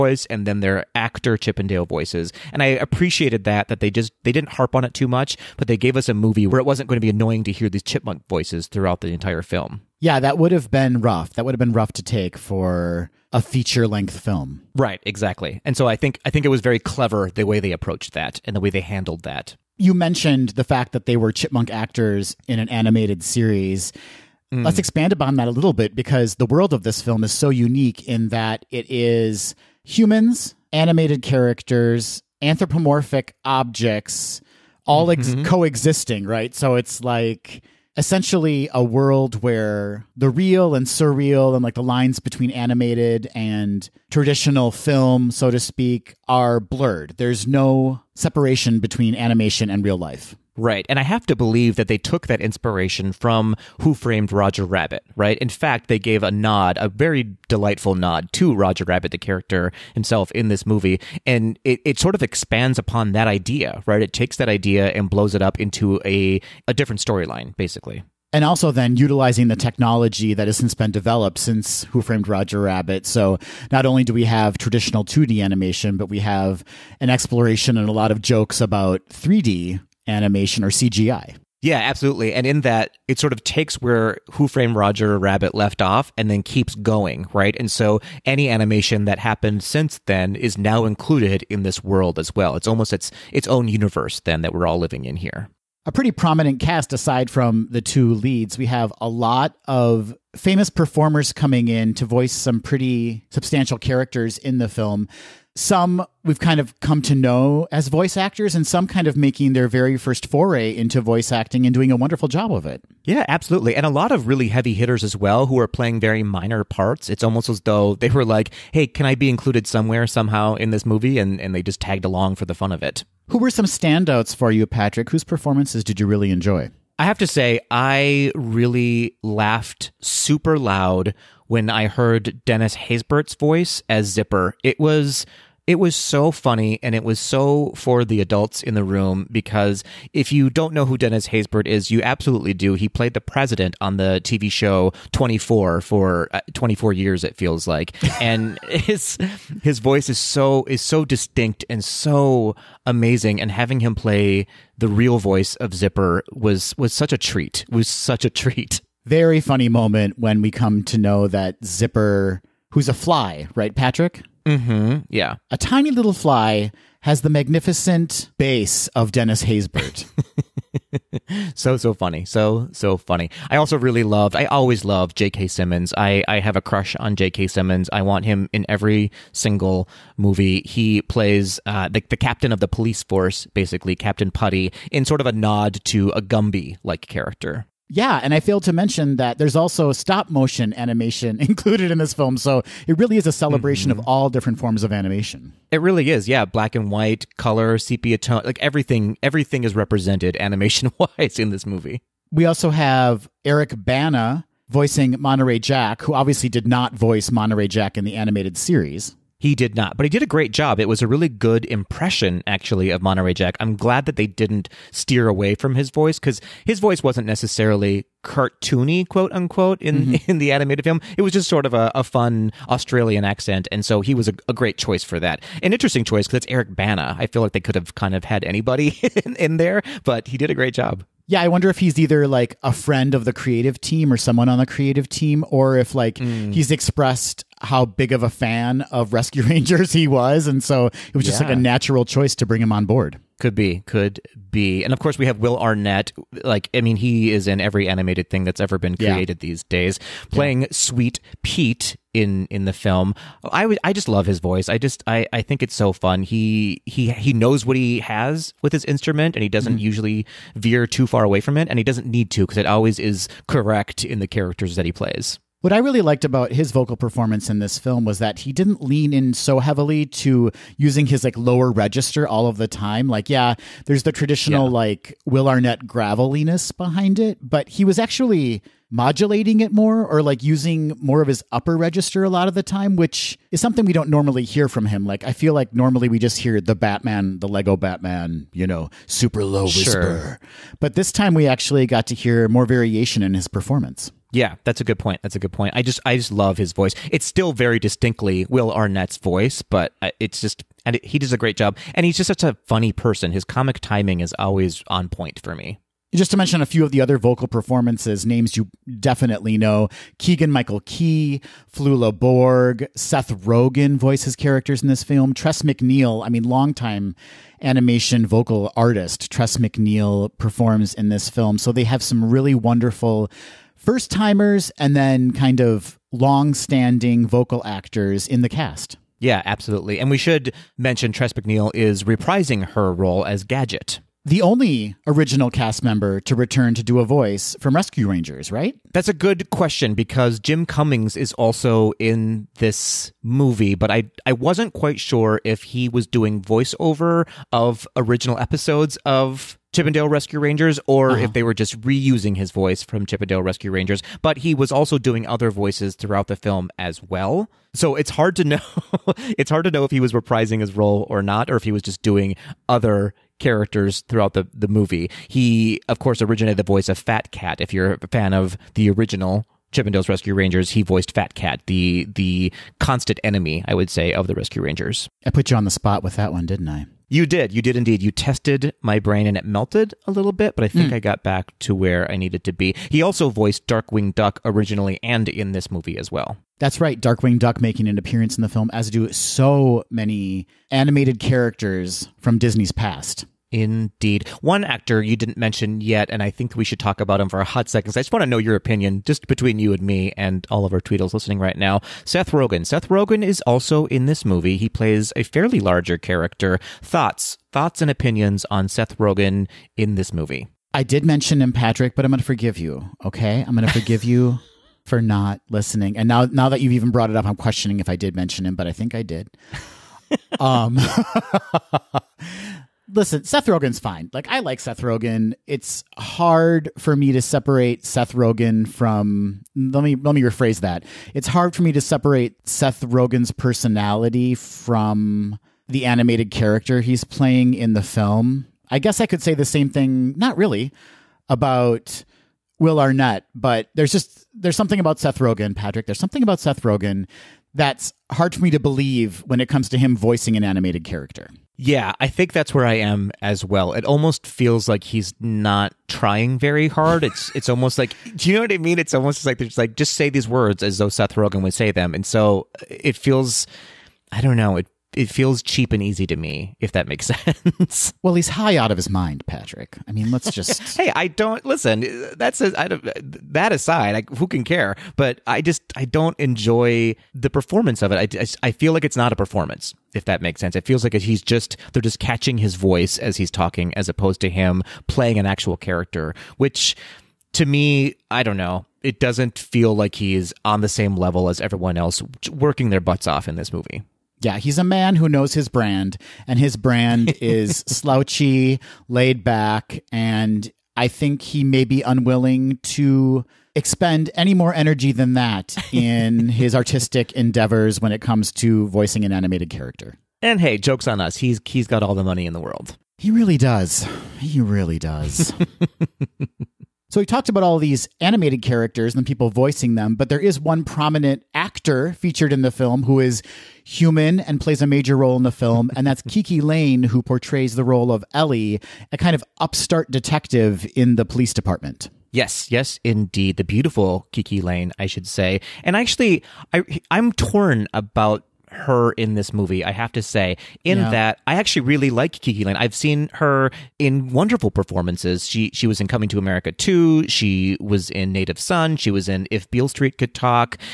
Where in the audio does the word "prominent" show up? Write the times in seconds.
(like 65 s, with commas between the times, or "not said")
96 s, 520 s.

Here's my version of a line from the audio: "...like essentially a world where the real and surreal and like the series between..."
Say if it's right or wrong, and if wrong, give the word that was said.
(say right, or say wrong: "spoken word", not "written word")
wrong: "lines", not "series".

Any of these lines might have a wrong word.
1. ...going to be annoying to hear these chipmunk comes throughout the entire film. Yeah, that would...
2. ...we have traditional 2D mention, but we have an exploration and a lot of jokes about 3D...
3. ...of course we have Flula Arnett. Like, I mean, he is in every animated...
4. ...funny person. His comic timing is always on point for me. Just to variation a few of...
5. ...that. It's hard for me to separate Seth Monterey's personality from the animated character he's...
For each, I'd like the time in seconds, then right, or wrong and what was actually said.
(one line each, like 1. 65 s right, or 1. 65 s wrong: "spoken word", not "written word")
1. 6 s wrong: "voices", not "comes"
2. 74 s wrong: "animation", not "mention"
3. 244 s wrong: "Will", not "Flula"
4. 302 s wrong: "mention", not "variation"
5. 430 s wrong: "Rogen", not "Monterey".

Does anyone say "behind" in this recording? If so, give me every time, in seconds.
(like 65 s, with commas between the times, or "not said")
276 s.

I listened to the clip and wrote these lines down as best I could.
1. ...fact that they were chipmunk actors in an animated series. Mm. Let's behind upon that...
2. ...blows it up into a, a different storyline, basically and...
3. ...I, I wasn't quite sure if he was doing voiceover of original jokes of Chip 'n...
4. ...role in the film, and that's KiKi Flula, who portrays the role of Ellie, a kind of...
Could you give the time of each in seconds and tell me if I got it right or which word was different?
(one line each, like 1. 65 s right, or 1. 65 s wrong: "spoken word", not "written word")
1. 20 s wrong: "expand", not "behind"
2. 65 s right
3. 343 s wrong: "episodes", not "jokes"
4. 524 s wrong: "Layne", not "Flula".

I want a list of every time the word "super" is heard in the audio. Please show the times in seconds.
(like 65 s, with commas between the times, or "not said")
130 s, 289 s.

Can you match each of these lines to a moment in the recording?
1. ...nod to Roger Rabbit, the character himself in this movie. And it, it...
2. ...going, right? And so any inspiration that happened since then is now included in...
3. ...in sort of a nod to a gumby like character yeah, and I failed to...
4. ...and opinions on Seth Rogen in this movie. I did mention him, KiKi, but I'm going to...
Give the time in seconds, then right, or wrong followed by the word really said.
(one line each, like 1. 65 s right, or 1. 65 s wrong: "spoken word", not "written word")
1. 57 s right
2. 86 s wrong: "animation", not "inspiration"
3. 184 s right
4. 407 s wrong: "Patrick", not "KiKi".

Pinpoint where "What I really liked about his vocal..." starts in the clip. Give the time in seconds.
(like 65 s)
265 s.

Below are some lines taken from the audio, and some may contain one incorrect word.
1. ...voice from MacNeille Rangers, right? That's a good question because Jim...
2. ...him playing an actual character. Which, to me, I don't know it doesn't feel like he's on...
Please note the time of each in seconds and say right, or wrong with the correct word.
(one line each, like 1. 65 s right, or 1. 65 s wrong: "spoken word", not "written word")
1. 337 s wrong: "Rescue", not "MacNeille"
2. 484 s right.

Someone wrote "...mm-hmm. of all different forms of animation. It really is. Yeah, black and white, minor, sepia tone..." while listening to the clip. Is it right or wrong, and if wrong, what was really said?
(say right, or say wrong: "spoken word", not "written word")
wrong: "color", not "minor".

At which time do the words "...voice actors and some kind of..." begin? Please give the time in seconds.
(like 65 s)
107 s.